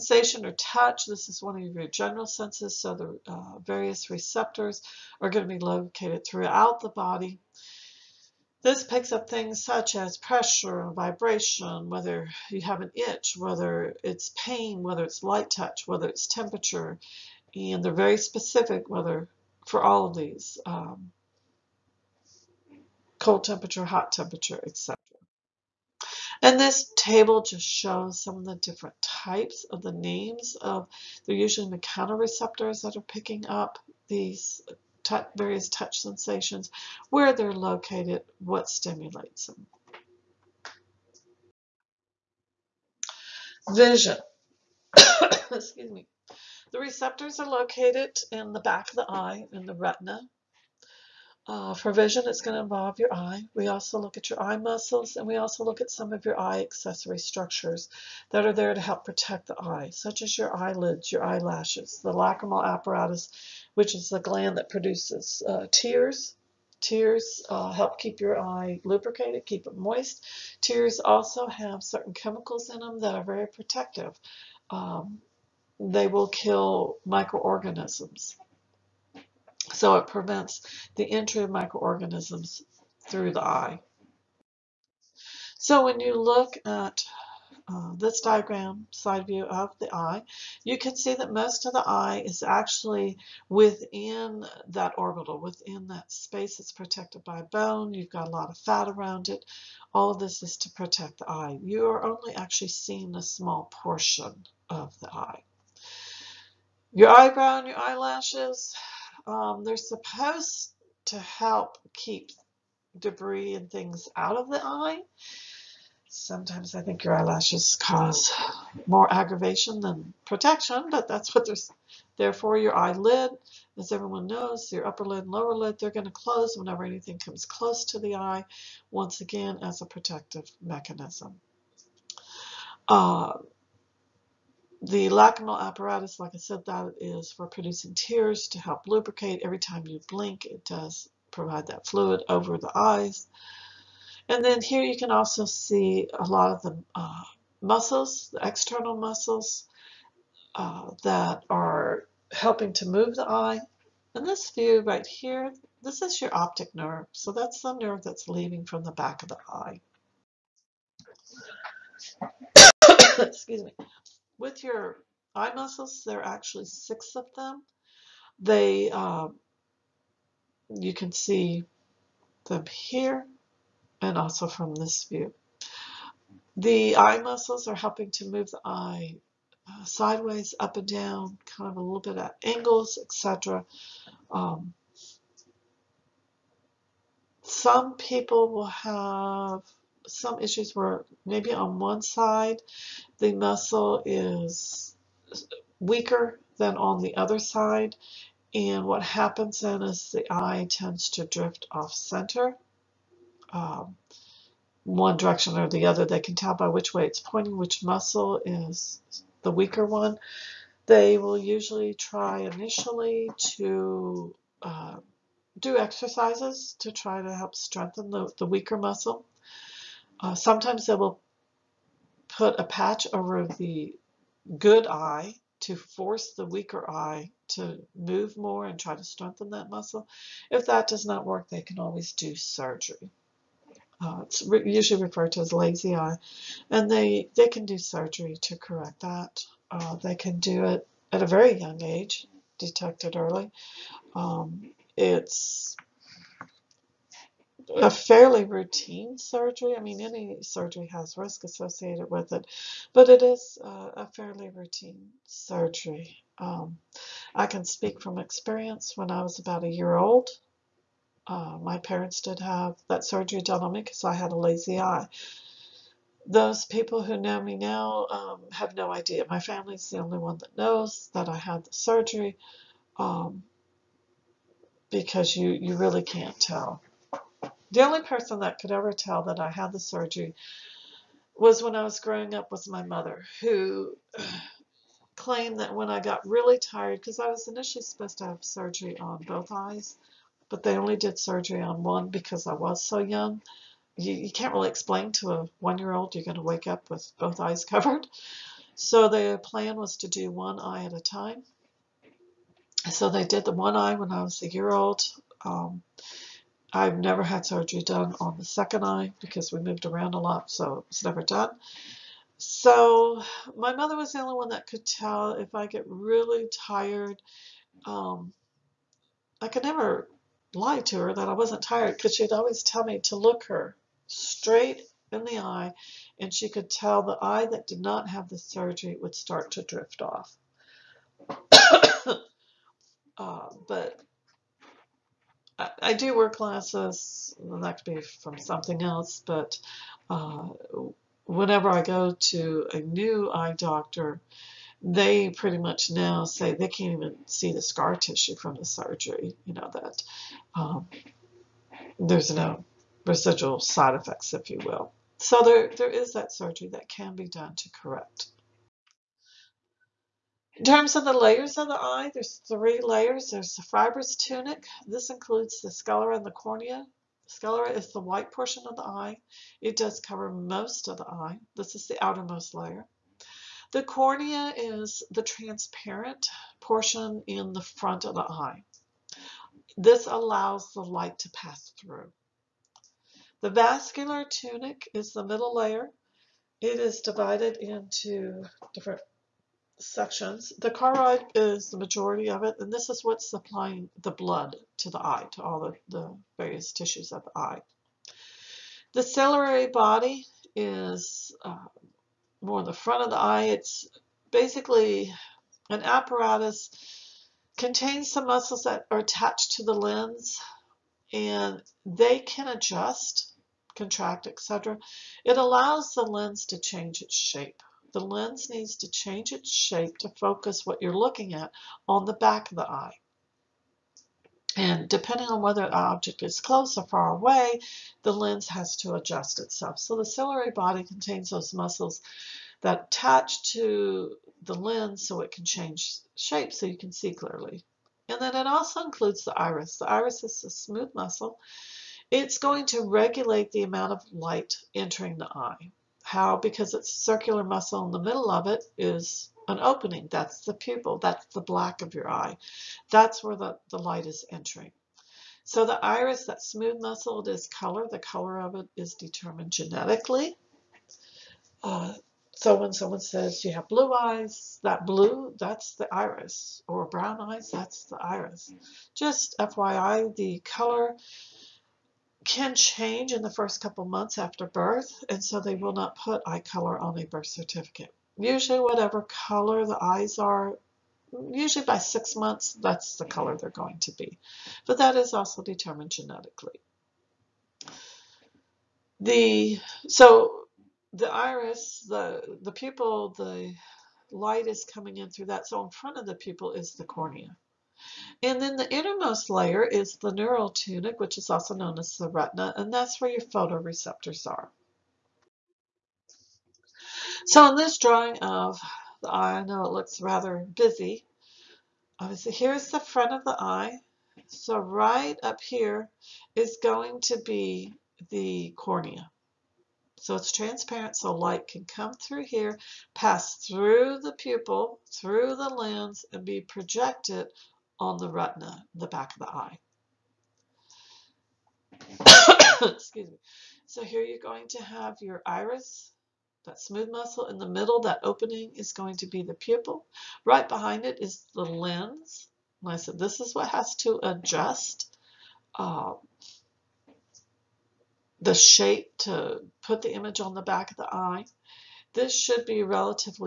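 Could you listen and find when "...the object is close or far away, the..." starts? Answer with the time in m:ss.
7:05.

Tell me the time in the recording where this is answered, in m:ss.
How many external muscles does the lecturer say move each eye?
2:46.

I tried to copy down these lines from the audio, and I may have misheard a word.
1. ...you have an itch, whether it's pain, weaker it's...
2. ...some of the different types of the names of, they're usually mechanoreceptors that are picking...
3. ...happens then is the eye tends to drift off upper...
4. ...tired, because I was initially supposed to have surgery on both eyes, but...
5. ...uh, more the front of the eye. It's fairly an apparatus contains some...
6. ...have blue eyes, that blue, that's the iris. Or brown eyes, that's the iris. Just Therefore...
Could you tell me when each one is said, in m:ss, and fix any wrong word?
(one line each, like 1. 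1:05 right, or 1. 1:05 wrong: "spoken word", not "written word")
1. 0:12 wrong: "whether", not "weaker"
2. 0:28 right
3. 3:19 wrong: "center", not "upper"
4. 4:46 right
5. 6:41 wrong: "basically", not "fairly"
6. 7:43 wrong: "FYI", not "Therefore".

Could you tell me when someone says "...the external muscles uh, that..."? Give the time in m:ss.
2:28.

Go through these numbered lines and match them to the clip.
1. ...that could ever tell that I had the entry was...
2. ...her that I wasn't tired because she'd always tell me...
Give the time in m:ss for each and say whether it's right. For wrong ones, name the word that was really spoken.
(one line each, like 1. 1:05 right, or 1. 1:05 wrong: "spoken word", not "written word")
1. 4:38 wrong: "surgery", not "entry"
2. 5:20 right.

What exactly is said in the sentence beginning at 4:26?
Those people who know me now um, have no idea.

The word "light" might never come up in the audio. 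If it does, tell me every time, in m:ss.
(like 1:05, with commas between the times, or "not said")
0:15, 6:20, 7:24, 7:33, 8:14, 8:41.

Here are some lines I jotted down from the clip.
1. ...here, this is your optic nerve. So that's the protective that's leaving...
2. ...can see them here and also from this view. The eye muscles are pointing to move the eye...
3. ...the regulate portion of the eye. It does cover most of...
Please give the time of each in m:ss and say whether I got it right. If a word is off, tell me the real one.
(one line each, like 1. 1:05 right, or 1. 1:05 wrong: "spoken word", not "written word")
1. 2:35 wrong: "nerve", not "protective"
2. 2:50 wrong: "helping", not "pointing"
3. 6:07 wrong: "white", not "regulate".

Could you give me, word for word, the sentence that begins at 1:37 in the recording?
You've got a lot of fat around it.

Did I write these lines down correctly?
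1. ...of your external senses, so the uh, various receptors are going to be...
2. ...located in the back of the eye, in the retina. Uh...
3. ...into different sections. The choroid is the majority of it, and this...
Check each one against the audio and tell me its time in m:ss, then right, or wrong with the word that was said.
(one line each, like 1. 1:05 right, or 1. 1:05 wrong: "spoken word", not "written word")
1. 0:01 wrong: "general", not "external"
2. 0:47 right
3. 6:27 right.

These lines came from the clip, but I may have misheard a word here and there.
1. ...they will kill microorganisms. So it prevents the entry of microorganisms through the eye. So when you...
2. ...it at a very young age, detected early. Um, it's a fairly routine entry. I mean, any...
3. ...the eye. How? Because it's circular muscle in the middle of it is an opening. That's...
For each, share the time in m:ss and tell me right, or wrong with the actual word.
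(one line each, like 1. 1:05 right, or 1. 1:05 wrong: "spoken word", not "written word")
1. 1:15 right
2. 4:00 wrong: "surgery", not "entry"
3. 7:25 right.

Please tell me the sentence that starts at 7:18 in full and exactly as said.
And then it also includes the iris.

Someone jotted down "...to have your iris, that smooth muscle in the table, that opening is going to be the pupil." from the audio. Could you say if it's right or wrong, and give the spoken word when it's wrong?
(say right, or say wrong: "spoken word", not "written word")
wrong: "middle", not "table".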